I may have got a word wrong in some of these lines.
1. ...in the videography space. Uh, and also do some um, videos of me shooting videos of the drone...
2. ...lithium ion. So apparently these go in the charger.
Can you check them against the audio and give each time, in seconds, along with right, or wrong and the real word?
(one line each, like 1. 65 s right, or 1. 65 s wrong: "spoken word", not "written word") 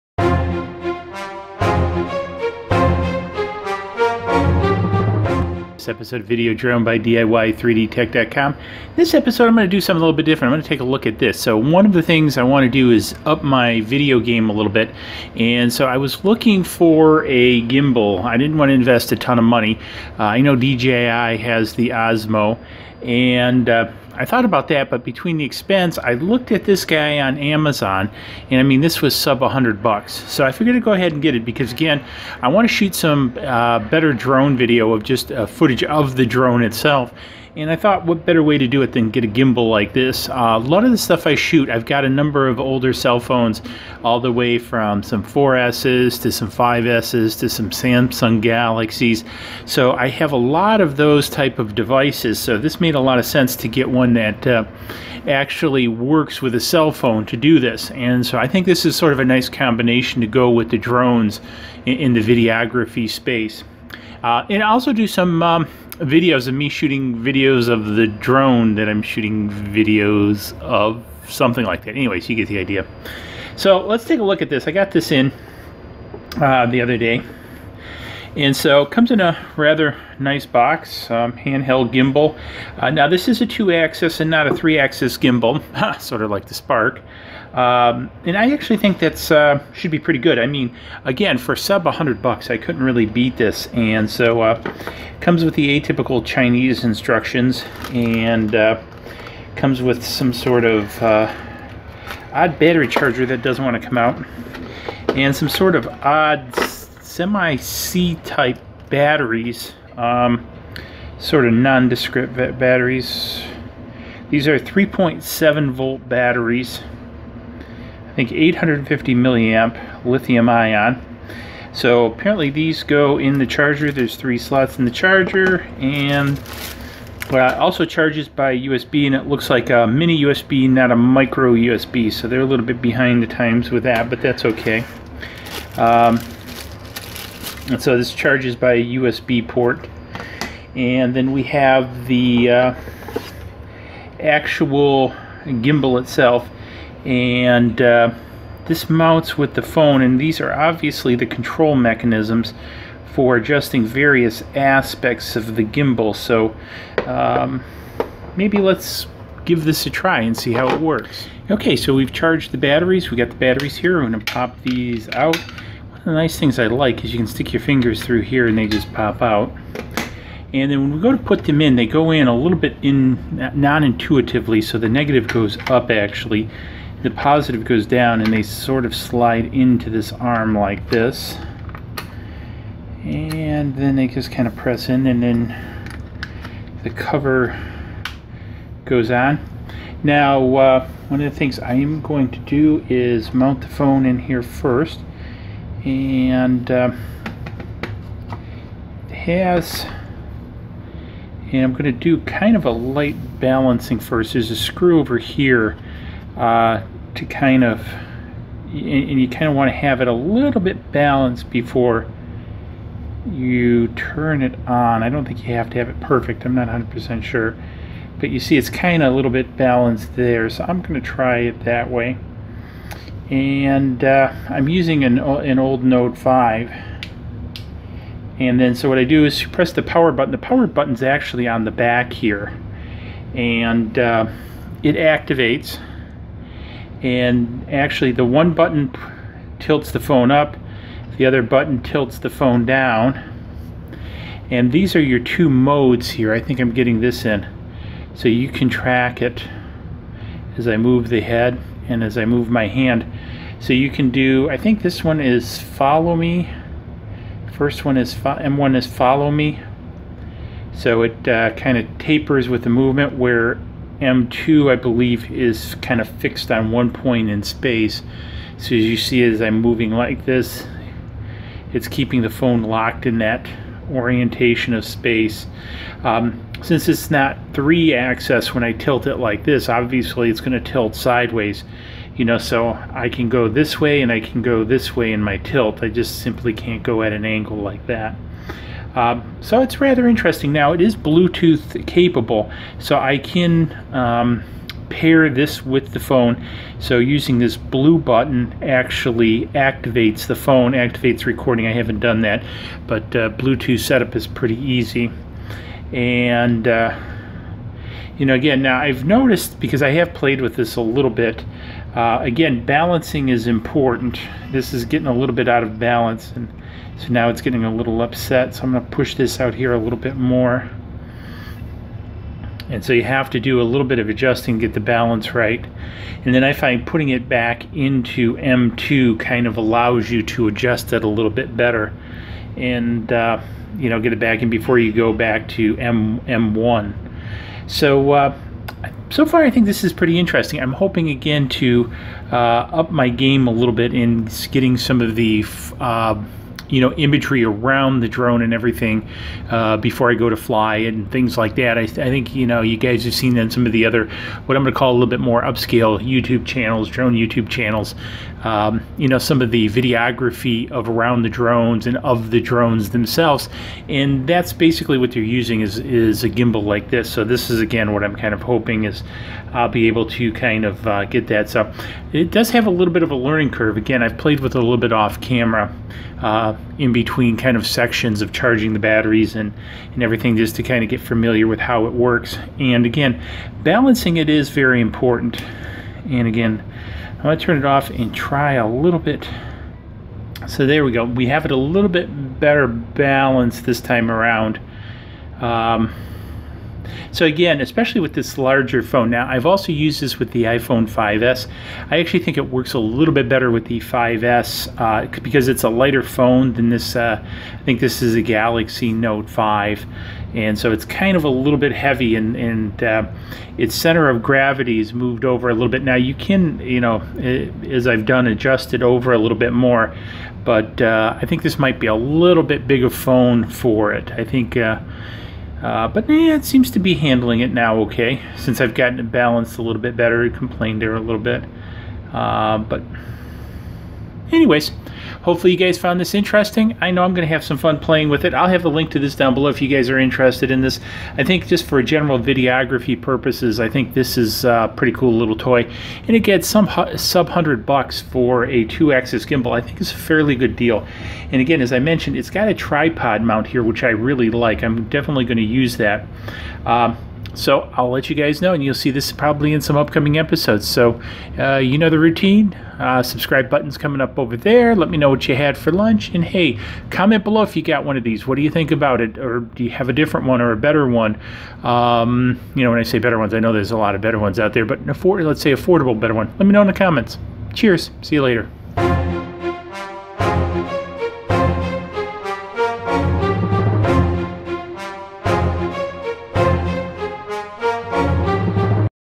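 1. 61 s right
2. 120 s right.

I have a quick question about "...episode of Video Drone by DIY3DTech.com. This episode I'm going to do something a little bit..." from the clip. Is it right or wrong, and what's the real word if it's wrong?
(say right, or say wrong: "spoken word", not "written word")
right.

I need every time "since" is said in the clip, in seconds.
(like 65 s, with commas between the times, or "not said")
276 s, 428 s.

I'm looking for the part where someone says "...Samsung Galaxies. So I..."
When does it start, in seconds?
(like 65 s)
47 s.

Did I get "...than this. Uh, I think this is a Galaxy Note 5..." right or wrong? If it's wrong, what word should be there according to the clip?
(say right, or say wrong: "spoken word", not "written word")
right.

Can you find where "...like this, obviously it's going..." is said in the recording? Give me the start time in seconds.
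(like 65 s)
279 s.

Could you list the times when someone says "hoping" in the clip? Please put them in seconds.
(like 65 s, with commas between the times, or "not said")
340 s, 368 s.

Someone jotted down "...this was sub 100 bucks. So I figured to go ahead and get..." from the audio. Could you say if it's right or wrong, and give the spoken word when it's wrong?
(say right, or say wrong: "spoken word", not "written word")
right.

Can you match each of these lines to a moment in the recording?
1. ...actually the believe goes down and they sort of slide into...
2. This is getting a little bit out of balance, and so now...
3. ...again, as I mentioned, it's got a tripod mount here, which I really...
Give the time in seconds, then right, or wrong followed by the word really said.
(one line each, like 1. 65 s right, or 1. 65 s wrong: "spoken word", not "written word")
1. 175 s wrong: "positive", not "believe"
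2. 314 s right
3. 451 s right.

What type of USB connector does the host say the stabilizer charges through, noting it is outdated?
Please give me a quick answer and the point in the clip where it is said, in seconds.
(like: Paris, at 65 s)
mini USB, at 129 s.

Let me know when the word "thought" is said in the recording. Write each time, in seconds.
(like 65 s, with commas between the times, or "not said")
24 s, 37 s.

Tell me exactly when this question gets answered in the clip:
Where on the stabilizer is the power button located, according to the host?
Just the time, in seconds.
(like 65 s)
231 s.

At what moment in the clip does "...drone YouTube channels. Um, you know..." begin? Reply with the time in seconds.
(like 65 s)
356 s.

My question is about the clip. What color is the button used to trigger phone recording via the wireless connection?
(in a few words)
Blue.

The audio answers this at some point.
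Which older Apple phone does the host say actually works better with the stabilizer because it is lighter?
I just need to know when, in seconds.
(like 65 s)
400 s.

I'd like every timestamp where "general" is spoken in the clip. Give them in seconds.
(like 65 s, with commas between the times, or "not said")
441 s.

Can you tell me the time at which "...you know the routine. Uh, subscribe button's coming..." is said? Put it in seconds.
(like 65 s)
461 s.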